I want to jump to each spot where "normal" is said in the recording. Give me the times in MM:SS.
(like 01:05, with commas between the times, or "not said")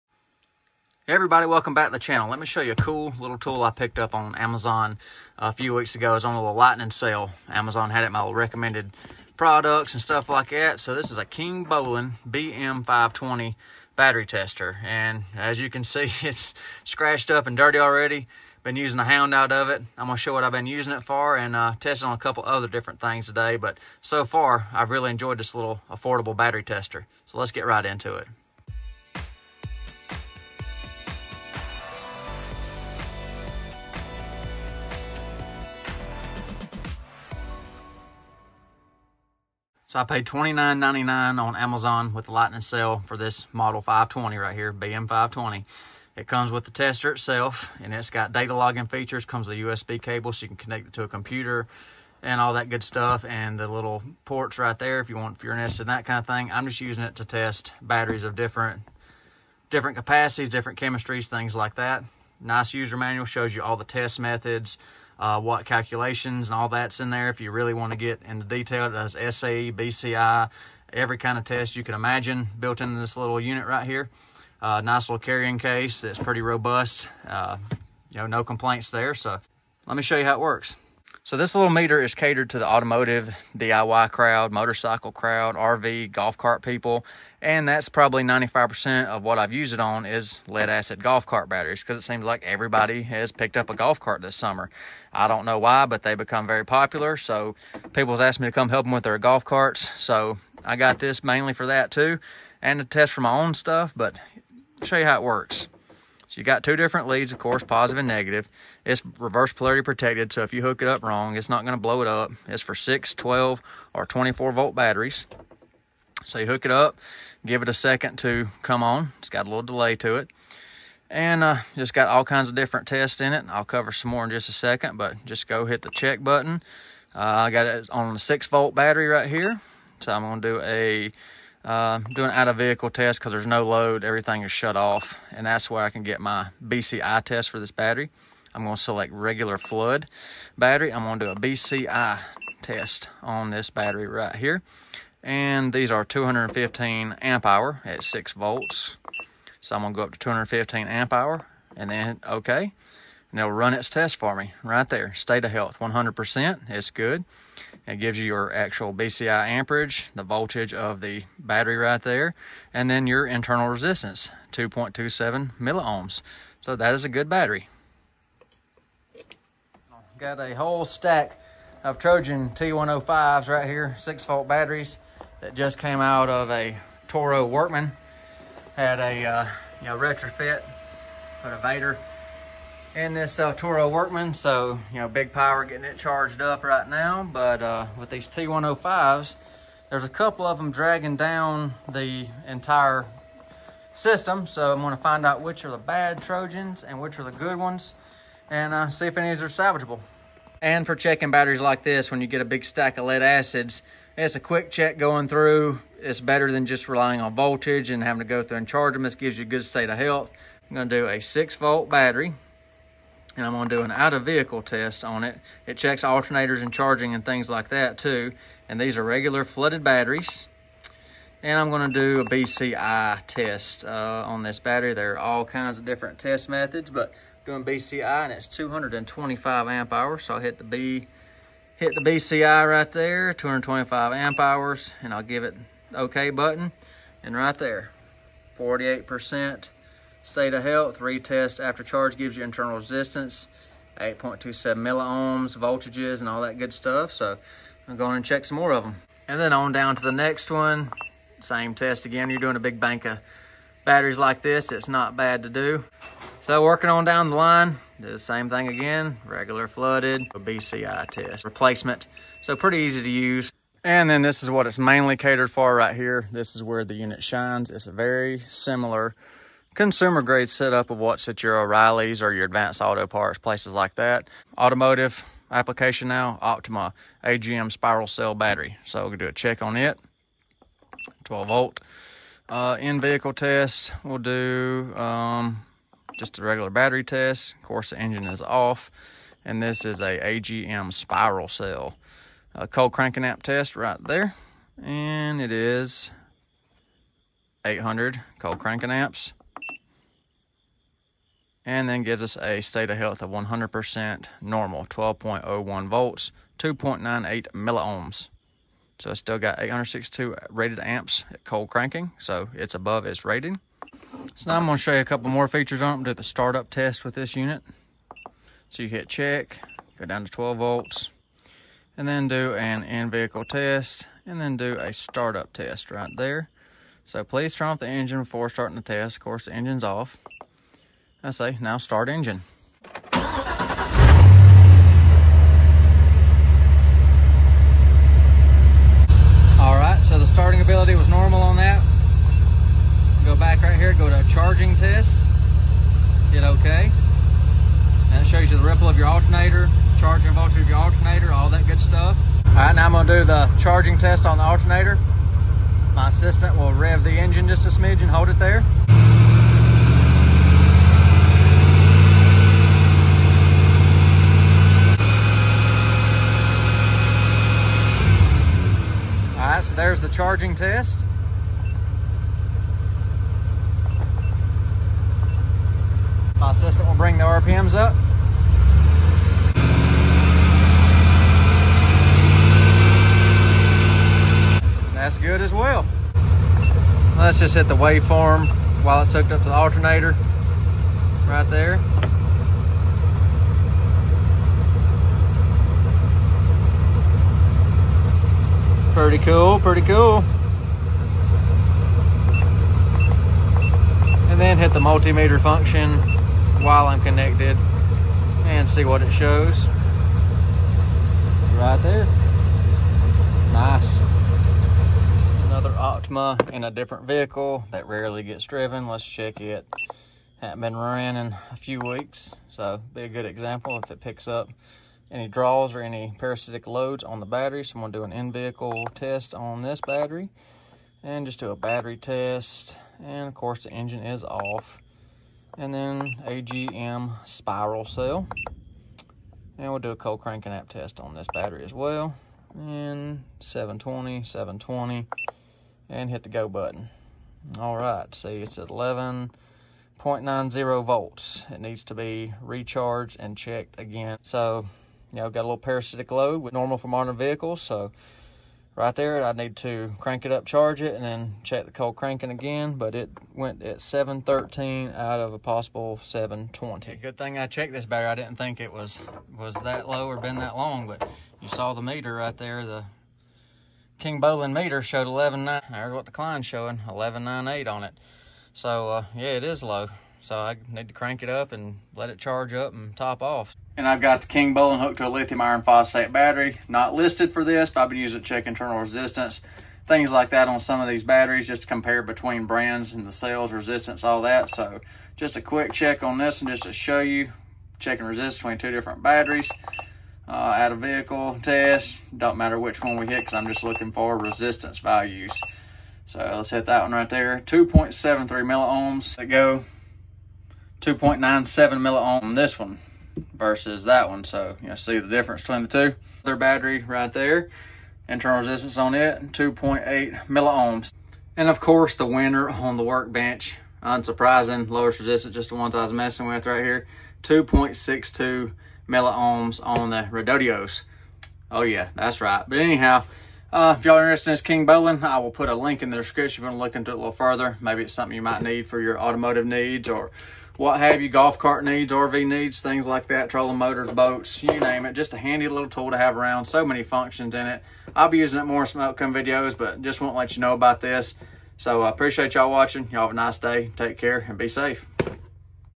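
05:04, 05:41, 07:36.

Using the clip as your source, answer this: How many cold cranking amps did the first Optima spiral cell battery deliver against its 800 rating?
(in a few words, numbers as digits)
862.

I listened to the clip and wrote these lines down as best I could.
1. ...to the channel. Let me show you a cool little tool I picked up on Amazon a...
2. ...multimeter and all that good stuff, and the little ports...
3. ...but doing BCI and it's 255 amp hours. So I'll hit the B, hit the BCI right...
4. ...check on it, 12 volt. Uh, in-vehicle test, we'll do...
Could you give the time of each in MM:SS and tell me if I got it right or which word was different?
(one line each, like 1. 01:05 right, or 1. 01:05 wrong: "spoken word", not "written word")
1. 00:01 right
2. 00:51 wrong: "computer", not "multimeter"
3. 03:46 wrong: "225", not "255"
4. 04:39 right.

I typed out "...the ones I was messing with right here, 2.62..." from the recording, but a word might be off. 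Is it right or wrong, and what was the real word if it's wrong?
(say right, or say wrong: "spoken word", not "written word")
right.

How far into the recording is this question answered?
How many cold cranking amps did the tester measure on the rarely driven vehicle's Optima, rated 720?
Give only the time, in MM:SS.
07:43.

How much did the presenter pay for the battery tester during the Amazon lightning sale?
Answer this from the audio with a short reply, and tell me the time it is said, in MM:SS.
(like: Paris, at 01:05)
$29.99, at 00:40.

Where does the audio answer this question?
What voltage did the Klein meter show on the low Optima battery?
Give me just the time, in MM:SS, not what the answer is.
07:56.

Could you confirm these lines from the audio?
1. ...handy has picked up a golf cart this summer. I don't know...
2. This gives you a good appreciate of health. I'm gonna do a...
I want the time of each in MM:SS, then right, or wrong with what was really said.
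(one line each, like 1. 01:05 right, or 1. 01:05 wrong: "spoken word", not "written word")
1. 01:32 wrong: "everybody", not "handy"
2. 03:29 wrong: "state", not "appreciate".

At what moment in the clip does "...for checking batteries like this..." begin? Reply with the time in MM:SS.
03:20.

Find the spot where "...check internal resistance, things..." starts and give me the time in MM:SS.
08:08.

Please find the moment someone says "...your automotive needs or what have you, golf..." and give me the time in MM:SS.
08:58.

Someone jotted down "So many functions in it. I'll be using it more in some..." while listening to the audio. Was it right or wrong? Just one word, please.
right.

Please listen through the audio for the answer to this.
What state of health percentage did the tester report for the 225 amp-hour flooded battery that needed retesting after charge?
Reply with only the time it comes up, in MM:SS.
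03:58.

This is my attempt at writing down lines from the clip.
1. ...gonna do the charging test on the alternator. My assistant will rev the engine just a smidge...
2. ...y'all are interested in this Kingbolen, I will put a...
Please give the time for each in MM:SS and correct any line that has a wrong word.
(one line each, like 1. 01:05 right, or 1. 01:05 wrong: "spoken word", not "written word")
1. 05:52 right
2. 08:53 right.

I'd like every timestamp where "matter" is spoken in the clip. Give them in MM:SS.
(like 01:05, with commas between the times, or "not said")
08:22.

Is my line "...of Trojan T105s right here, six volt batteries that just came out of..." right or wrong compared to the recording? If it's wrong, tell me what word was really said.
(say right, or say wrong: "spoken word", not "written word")
right.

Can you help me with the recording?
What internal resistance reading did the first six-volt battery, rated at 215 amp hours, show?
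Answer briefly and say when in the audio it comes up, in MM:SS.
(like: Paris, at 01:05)
2.27 milliohms, at 02:44.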